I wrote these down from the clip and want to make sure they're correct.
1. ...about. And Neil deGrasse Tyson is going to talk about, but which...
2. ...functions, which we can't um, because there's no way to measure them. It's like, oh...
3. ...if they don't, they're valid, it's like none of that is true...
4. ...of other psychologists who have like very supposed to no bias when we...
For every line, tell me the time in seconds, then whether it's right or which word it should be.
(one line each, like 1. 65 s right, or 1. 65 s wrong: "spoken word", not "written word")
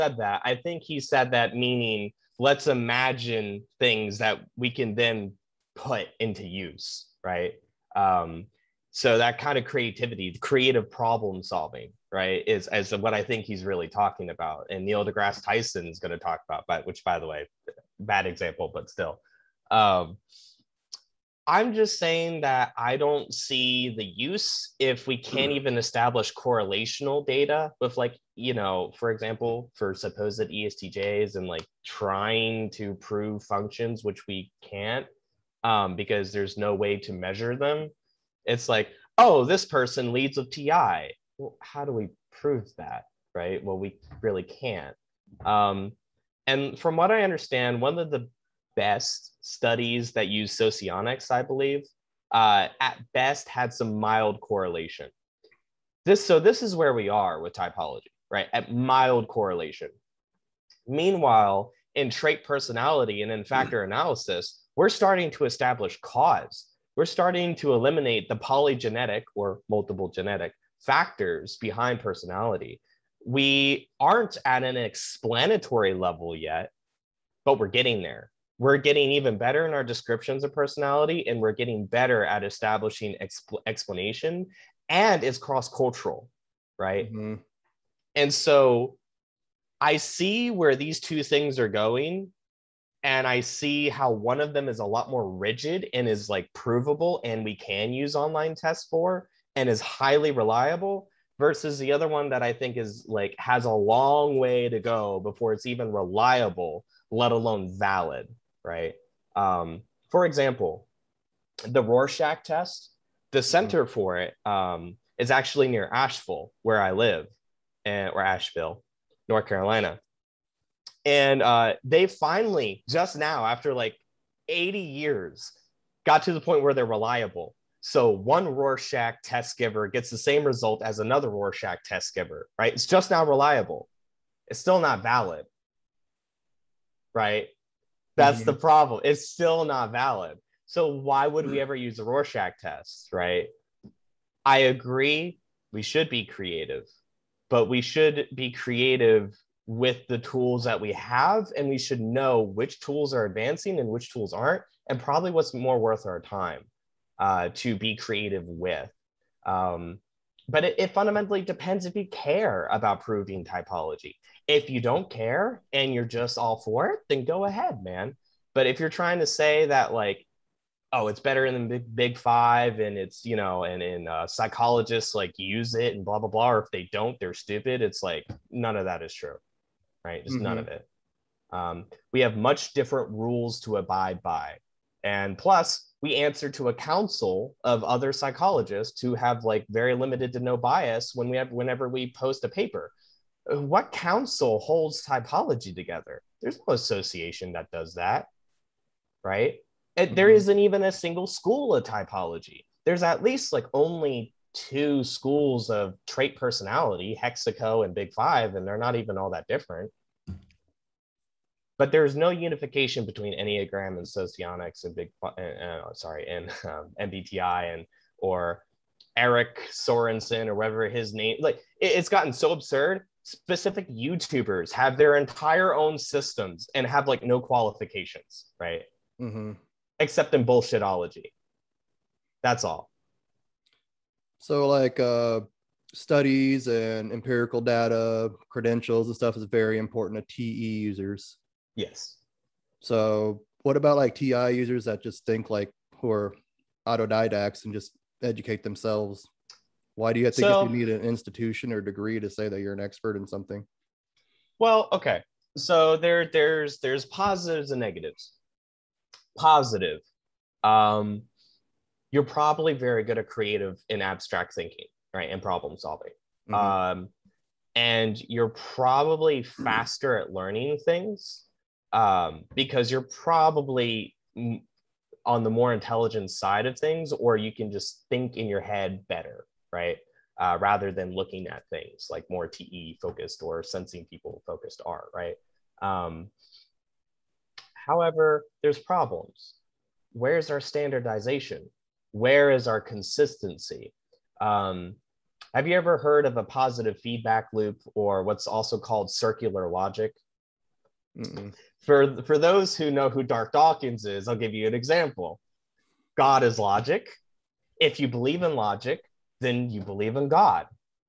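1. 14 s right
2. 33 s right
3. 176 s wrong: "stupid", not "valid"
4. 187 s wrong: "limited", not "supposed".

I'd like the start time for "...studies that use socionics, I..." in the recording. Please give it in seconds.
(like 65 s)
49 s.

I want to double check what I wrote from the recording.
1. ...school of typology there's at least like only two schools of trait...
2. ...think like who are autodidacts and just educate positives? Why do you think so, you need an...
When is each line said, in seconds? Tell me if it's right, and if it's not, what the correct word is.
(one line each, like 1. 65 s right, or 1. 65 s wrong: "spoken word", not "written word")
1. 201 s right
2. 245 s wrong: "themselves", not "positives".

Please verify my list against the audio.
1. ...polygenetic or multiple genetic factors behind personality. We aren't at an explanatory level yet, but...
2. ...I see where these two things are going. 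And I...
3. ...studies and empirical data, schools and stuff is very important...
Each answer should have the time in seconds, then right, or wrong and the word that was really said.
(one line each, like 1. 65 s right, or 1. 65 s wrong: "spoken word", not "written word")
1. 68 s right
2. 89 s right
3. 235 s wrong: "credentials", not "schools".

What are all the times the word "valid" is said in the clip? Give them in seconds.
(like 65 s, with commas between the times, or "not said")
107 s, 135 s, 139 s.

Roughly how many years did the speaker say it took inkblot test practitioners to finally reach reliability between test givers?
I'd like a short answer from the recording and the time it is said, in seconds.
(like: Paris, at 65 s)
80, at 124 s.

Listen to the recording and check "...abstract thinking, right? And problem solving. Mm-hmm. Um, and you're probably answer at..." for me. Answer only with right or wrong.
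wrong.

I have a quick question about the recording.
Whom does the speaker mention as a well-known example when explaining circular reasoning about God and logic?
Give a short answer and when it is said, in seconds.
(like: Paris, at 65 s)
Darth Dawkins, at 303 s.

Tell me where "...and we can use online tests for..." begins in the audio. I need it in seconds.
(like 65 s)
97 s.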